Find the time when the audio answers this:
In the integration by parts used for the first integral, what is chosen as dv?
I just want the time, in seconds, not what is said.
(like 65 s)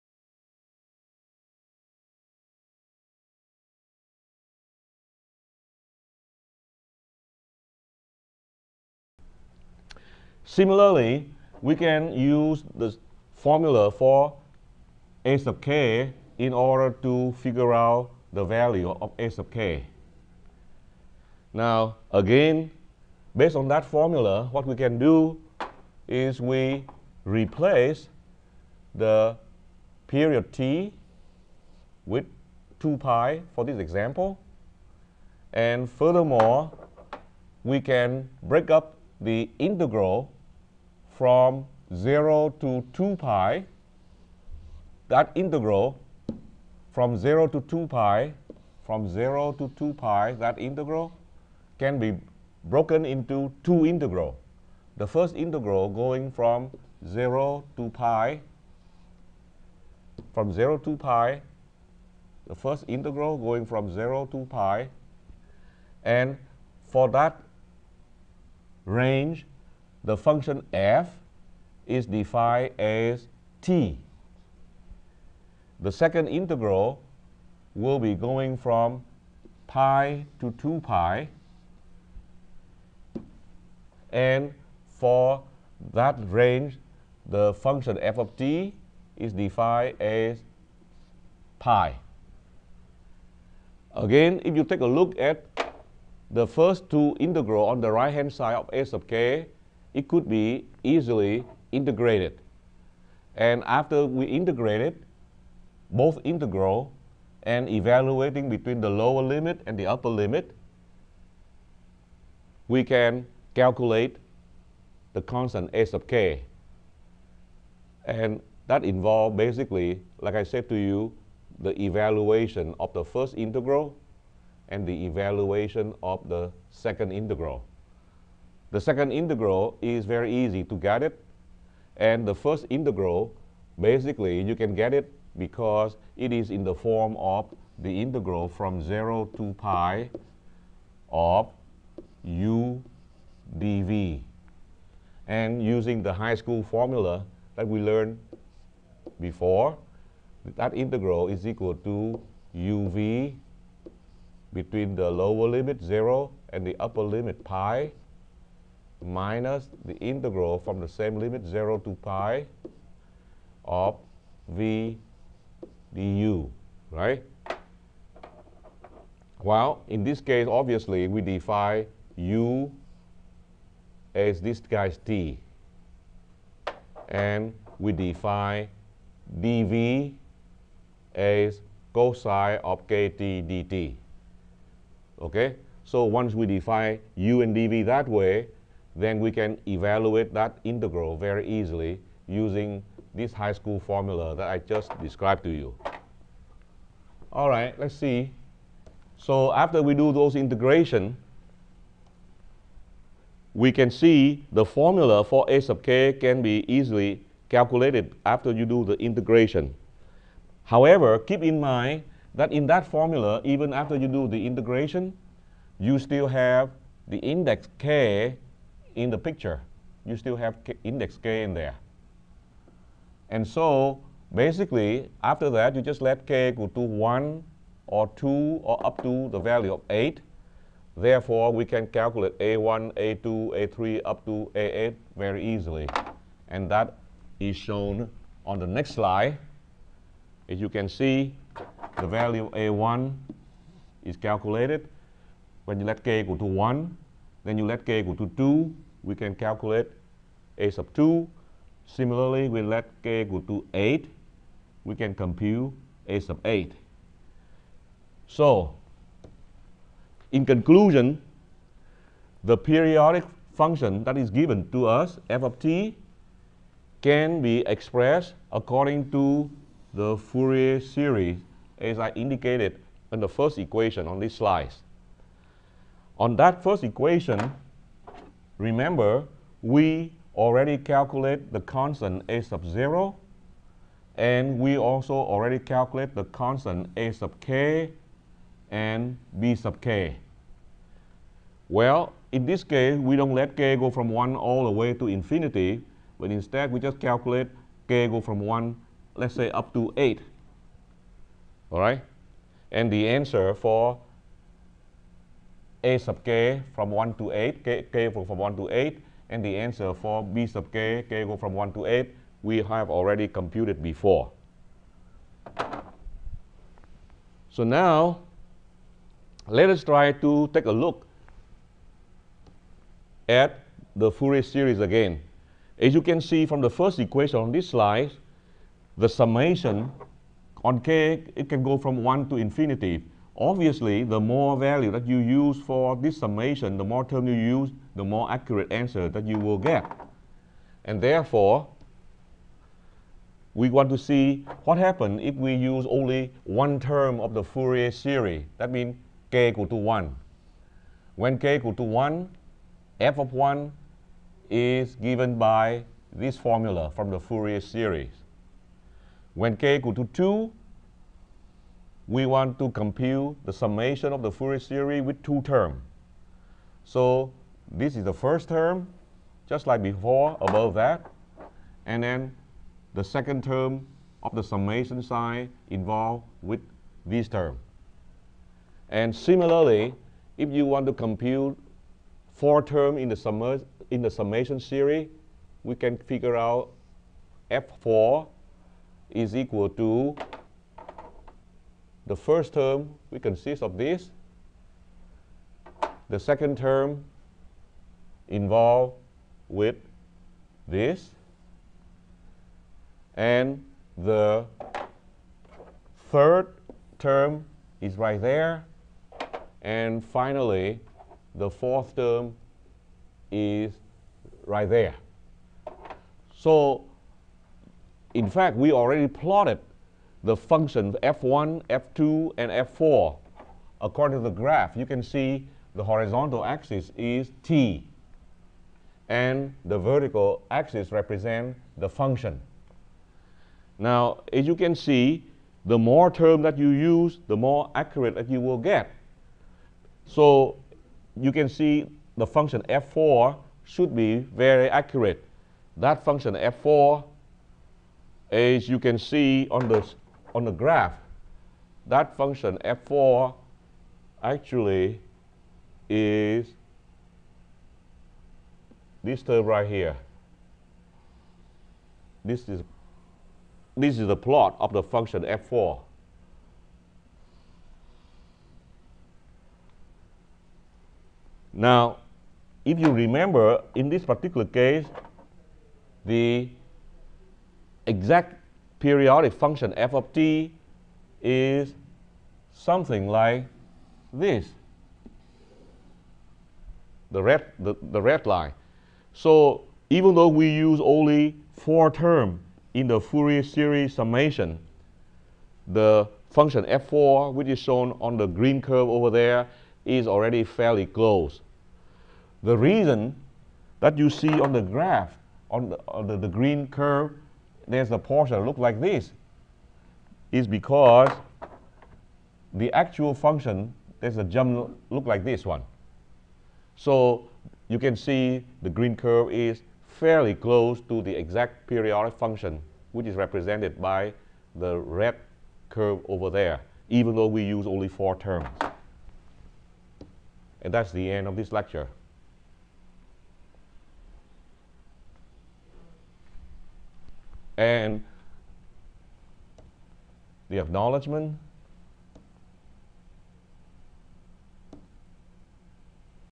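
181 s.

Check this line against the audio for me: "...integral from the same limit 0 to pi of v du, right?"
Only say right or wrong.
right.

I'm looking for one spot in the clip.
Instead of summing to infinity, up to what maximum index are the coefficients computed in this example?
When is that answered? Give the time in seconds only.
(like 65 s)
228 s.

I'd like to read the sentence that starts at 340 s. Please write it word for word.
And therefore, we want to see what happens if we use only one term of the Fourier series.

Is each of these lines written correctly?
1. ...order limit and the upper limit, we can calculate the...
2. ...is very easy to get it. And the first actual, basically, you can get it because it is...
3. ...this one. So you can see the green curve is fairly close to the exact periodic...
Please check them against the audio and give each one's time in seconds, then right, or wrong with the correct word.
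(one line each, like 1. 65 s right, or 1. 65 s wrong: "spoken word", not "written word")
1. 108 s wrong: "lower", not "order"
2. 129 s wrong: "integral", not "actual"
3. 515 s right.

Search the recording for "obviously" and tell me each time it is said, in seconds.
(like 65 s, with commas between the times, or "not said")
170 s, 333 s.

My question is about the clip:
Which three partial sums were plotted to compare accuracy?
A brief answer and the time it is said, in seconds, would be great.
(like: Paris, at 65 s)
f1, f2, f4, at 421 s.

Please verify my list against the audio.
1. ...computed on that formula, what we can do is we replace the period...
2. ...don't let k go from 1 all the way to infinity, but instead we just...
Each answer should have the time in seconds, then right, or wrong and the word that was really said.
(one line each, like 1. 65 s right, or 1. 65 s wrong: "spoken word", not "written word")
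1. 23 s wrong: "based", not "computed"
2. 293 s right.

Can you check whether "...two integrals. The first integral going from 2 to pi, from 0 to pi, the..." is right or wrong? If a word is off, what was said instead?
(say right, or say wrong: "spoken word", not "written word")
wrong: "0", not "2".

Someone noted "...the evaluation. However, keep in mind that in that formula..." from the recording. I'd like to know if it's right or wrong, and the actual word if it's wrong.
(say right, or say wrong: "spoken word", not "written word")
wrong: "integration", not "evaluation".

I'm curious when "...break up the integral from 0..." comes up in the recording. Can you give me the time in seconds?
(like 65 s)
38 s.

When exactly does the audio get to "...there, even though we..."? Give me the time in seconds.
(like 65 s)
526 s.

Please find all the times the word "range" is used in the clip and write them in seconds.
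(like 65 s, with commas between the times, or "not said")
68 s, 86 s.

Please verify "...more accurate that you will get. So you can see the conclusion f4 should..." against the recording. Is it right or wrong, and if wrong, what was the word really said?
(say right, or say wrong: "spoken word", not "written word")
wrong: "function", not "conclusion".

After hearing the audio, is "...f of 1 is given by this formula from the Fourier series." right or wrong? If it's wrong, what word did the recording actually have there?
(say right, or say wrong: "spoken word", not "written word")
right.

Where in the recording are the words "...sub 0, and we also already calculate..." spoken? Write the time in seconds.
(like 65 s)
282 s.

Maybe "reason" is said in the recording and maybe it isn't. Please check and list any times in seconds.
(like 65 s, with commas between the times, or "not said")
502 s.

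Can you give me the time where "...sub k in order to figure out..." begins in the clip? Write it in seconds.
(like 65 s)
15 s.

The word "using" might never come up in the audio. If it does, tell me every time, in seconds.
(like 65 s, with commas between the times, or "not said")
145 s, 192 s.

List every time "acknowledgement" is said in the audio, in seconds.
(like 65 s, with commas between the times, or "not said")
540 s.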